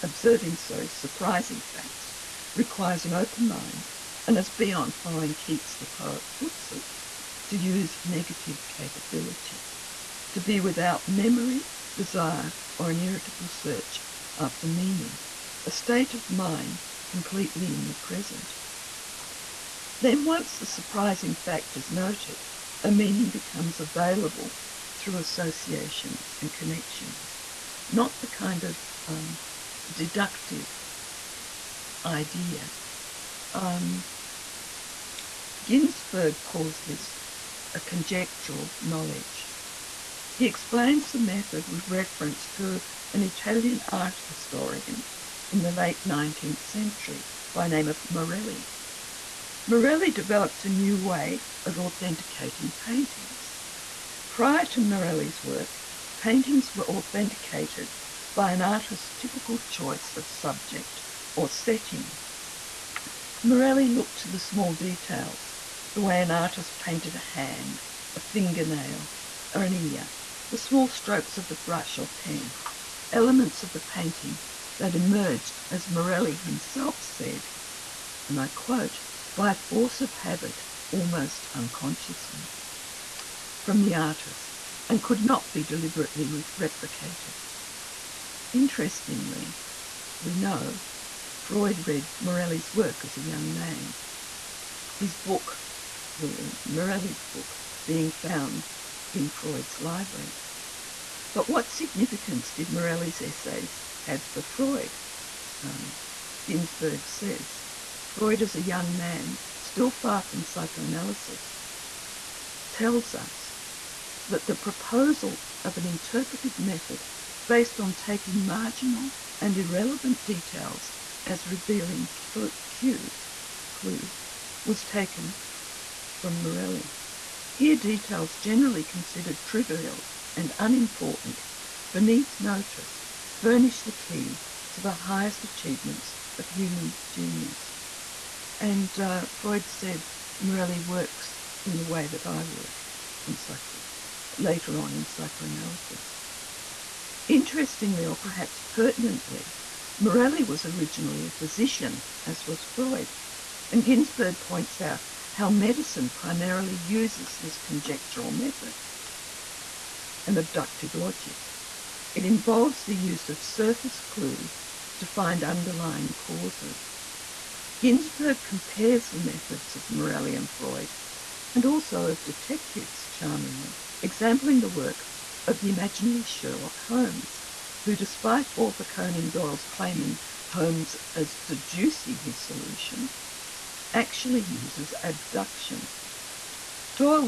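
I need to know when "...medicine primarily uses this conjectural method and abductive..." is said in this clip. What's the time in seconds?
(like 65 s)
155 s.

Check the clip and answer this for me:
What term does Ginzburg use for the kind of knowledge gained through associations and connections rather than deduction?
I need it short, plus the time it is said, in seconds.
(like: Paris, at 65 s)
conjectural knowledge, at 37 s.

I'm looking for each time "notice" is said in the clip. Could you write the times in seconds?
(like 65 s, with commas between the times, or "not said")
132 s.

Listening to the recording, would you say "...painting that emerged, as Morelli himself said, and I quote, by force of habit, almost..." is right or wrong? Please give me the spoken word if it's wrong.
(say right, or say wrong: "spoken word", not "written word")
right.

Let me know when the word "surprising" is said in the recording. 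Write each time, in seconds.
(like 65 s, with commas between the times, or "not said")
0 s, 20 s.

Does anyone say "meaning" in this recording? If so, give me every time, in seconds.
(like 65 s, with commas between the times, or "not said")
14 s, 22 s.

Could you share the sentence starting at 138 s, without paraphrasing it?
And uh, Freud said Morelli works in the way that I work in psycho- later on in psychoanalysis.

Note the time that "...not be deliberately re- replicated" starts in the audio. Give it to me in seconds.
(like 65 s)
85 s.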